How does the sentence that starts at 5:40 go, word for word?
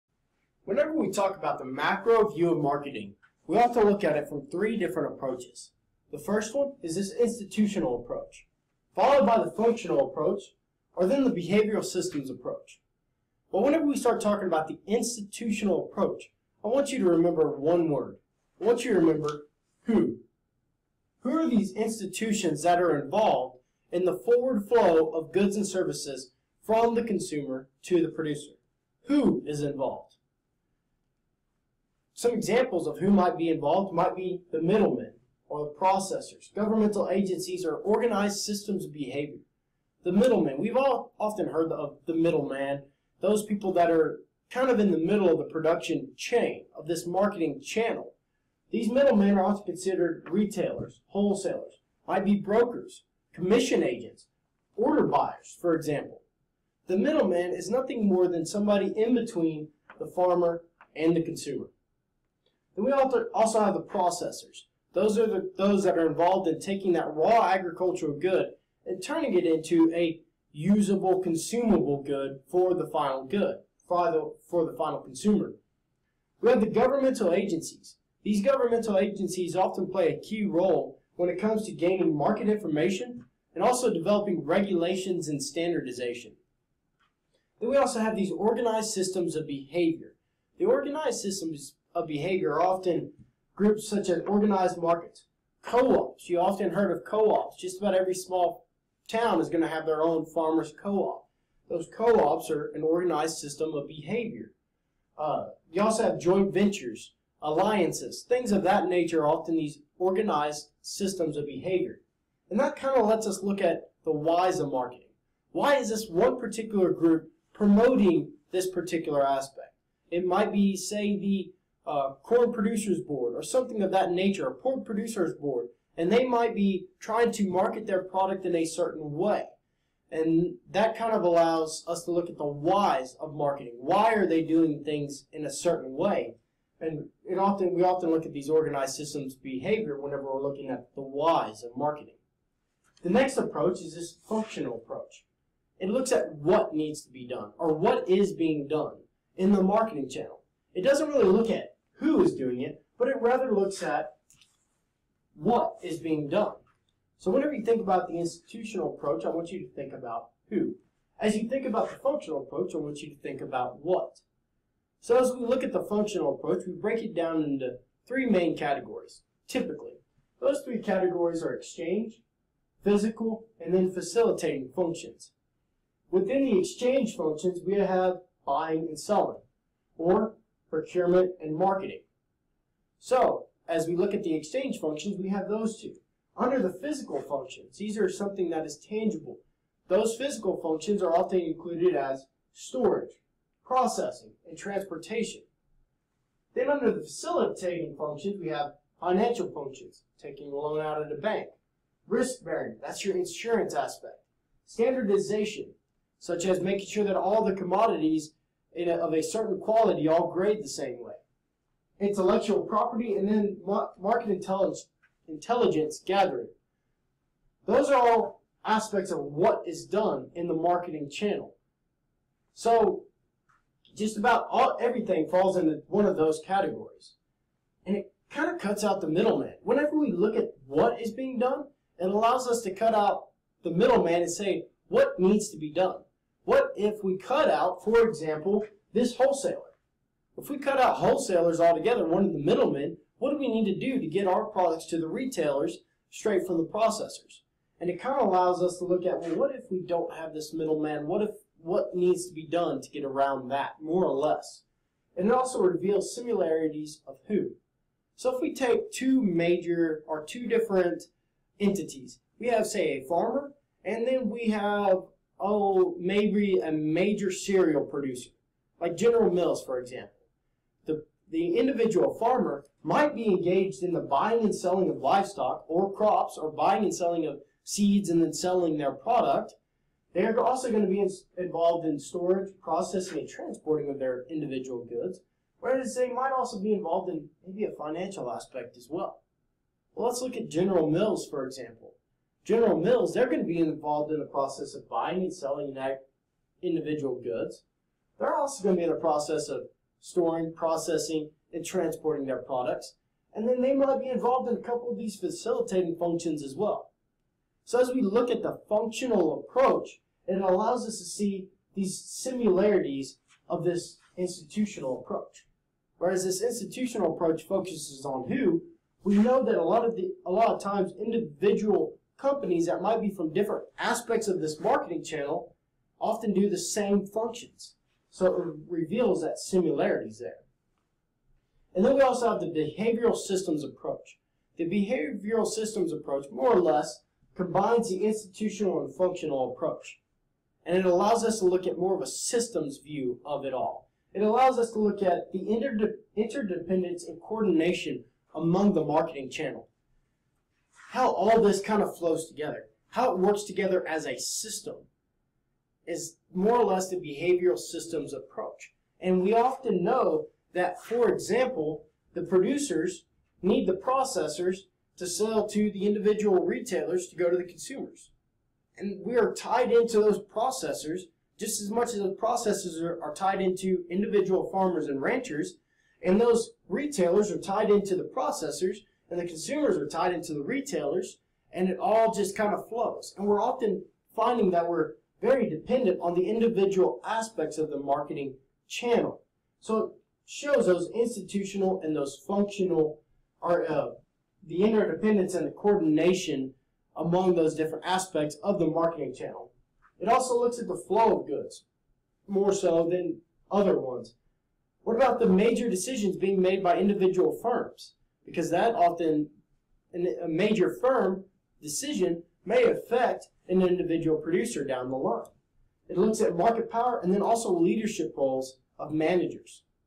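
And it allows us to look at more of a systems view of it all.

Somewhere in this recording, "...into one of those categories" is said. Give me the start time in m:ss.
3:45.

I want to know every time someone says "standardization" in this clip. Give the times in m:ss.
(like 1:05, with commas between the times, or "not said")
1:25, 3:24.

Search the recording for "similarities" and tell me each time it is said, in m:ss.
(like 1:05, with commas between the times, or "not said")
4:16, 5:11, 5:29.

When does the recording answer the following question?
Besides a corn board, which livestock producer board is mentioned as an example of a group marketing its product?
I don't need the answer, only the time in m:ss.
2:04.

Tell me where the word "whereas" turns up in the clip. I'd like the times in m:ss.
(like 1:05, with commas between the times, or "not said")
4:45, 5:15.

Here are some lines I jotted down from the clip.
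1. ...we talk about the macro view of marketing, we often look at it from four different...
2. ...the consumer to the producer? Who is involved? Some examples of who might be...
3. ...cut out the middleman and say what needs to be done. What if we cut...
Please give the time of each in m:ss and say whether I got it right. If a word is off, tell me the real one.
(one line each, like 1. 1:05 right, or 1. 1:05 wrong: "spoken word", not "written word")
1. 0:00 wrong: "three", not "four"
2. 0:26 right
3. 3:52 right.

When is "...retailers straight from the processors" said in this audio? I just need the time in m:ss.
4:05.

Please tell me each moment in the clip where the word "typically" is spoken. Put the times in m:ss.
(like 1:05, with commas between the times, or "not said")
2:49.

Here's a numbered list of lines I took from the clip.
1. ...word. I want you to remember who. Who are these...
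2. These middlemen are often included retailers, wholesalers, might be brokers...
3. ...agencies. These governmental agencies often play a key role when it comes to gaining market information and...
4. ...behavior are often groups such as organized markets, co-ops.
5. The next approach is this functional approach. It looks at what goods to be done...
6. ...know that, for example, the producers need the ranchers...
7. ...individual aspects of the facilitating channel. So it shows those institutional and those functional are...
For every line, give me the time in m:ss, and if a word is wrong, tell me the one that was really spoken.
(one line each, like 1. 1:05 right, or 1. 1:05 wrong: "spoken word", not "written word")
1. 0:17 right
2. 0:48 wrong: "considered", not "included"
3. 1:17 right
4. 1:32 right
5. 2:23 wrong: "needs", not "goods"
6. 5:59 wrong: "processors", not "ranchers"
7. 6:26 wrong: "marketing", not "facilitating".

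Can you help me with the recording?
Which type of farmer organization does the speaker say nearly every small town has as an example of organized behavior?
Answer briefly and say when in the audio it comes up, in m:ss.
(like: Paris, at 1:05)
Farmers co-op, at 1:40.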